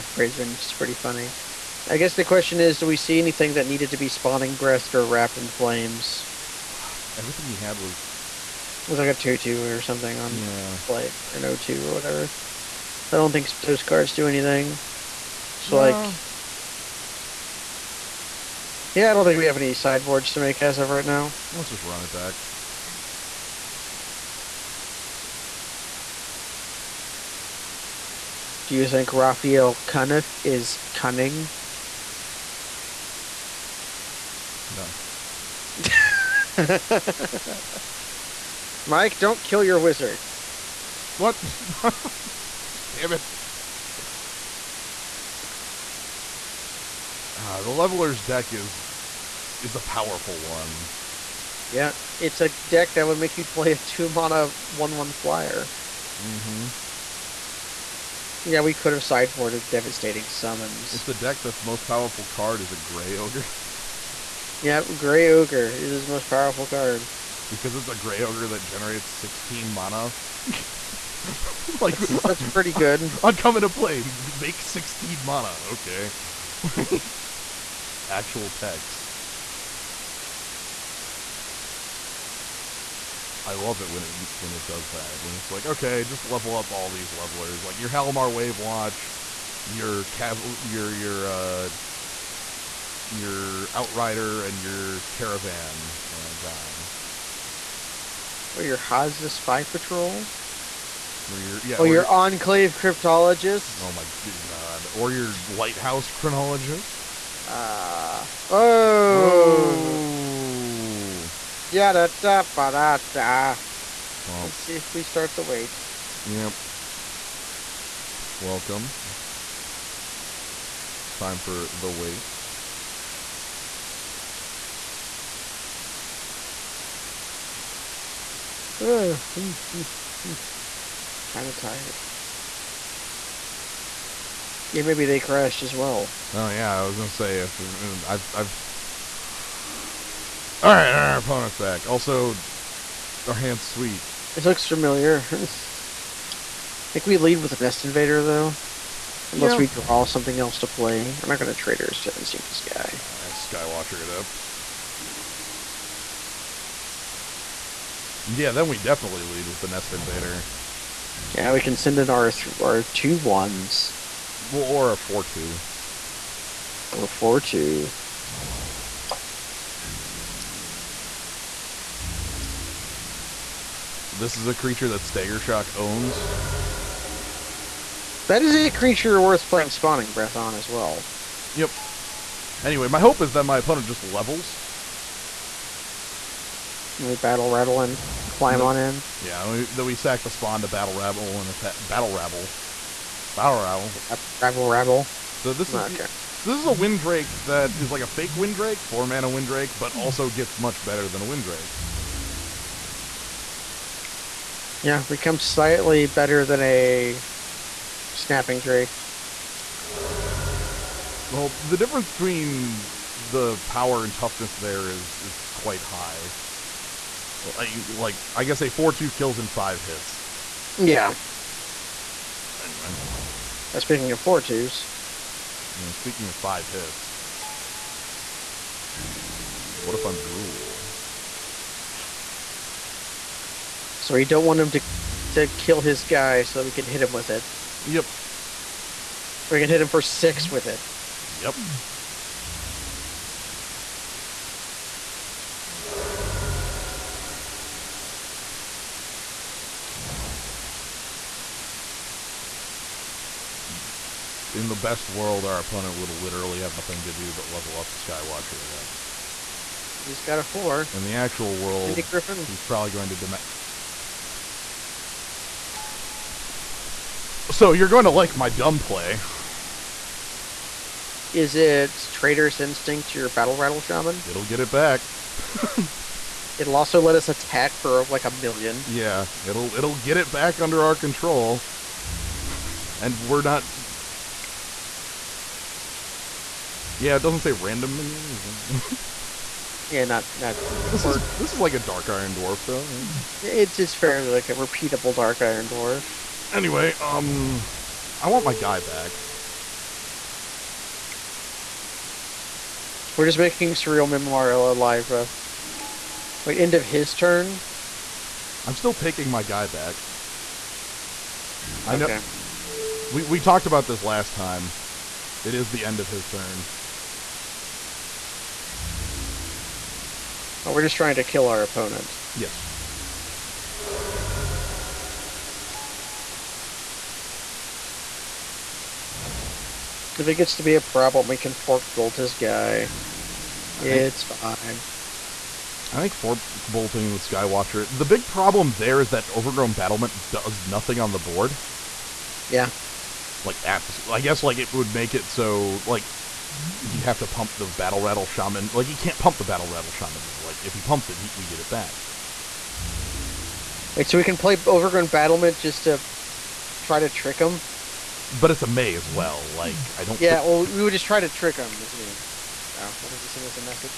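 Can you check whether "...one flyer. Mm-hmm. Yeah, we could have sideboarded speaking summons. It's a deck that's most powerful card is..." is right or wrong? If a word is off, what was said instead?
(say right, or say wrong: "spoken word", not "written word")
wrong: "devastating", not "speaking".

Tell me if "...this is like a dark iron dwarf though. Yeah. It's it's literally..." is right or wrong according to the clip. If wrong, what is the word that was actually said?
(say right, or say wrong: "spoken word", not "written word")
wrong: "fairly", not "literally".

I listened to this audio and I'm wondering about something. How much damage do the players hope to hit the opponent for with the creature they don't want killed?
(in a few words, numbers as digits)
6.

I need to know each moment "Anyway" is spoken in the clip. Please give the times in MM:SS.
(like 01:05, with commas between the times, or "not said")
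03:02, 03:42, 04:56.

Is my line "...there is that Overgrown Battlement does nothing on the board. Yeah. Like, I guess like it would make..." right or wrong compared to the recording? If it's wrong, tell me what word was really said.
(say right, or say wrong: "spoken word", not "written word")
right.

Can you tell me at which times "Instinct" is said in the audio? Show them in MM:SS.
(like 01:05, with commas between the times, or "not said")
02:32, 04:32.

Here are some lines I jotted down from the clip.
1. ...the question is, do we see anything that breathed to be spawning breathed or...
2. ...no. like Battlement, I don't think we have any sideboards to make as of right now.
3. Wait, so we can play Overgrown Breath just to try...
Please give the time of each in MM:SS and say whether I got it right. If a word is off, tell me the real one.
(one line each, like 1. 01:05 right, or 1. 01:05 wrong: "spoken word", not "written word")
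1. 00:02 wrong: "needed", not "breathed"
2. 00:15 wrong: "Yeah", not "Battlement"
3. 05:53 wrong: "Battlement", not "Breath".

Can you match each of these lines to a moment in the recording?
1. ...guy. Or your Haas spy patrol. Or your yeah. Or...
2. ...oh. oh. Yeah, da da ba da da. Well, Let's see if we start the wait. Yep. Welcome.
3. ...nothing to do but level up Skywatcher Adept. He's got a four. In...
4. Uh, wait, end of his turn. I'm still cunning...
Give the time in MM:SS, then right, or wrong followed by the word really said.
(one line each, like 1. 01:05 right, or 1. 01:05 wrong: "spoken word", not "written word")
1. 01:36 right
2. 01:48 right
3. 04:16 right
4. 05:05 wrong: "taking", not "cunning".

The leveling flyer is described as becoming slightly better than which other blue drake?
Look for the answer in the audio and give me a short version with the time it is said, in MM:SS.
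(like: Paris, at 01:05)
Snapping Drake, at 03:28.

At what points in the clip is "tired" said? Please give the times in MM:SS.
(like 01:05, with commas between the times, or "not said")
02:11.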